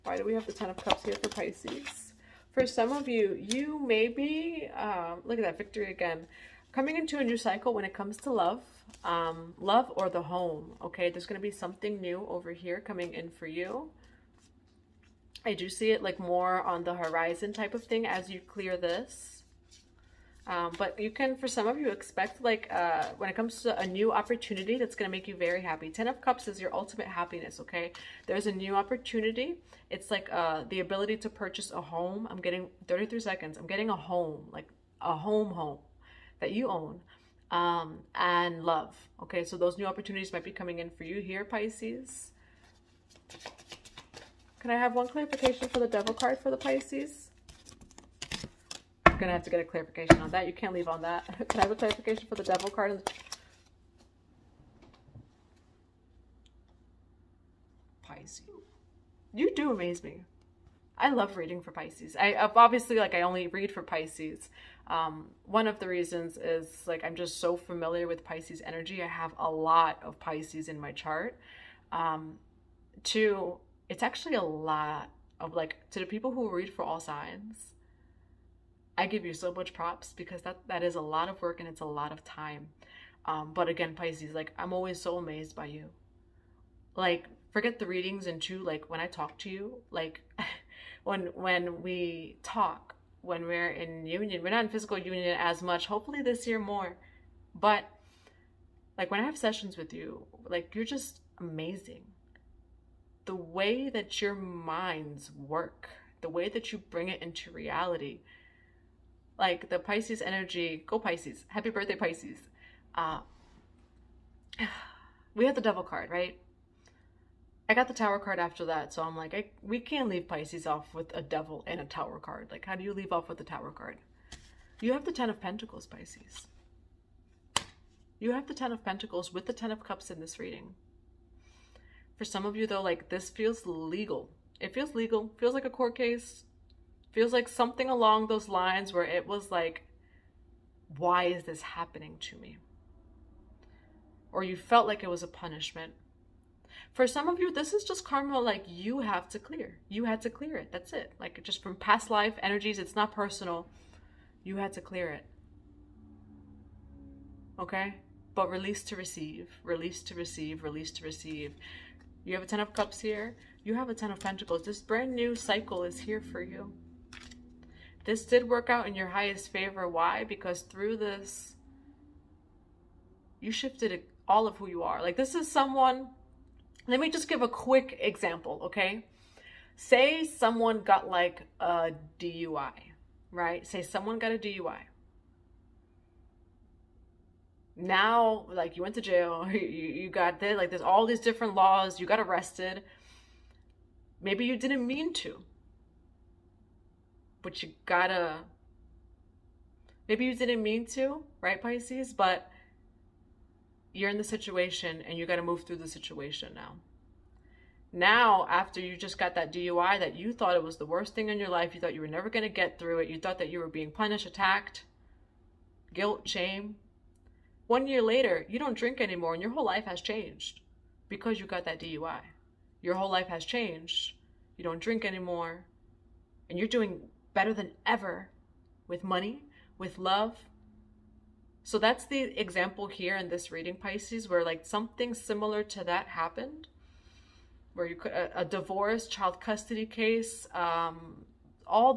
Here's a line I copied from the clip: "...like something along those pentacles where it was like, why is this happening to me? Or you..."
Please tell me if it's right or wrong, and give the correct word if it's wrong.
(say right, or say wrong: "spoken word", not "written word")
wrong: "lines", not "pentacles".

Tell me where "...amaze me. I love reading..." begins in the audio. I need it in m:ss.
0:59.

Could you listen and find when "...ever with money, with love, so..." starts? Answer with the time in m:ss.
3:47.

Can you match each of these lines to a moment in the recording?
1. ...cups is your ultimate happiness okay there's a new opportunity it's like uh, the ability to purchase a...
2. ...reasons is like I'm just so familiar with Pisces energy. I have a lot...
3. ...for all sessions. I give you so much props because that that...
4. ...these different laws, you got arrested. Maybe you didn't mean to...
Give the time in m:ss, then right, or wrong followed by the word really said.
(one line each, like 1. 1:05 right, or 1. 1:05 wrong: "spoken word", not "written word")
1. 0:26 right
2. 1:05 right
3. 1:16 wrong: "signs", not "sessions"
4. 3:11 right.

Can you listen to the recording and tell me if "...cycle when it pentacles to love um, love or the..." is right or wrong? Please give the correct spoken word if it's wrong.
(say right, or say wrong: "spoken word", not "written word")
wrong: "comes", not "pentacles".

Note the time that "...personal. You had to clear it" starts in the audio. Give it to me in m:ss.
2:33.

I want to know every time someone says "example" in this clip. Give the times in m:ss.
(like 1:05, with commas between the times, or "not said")
2:57, 3:52.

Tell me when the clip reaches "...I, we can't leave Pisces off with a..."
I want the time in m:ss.
1:59.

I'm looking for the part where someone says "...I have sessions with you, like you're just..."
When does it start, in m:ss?
1:39.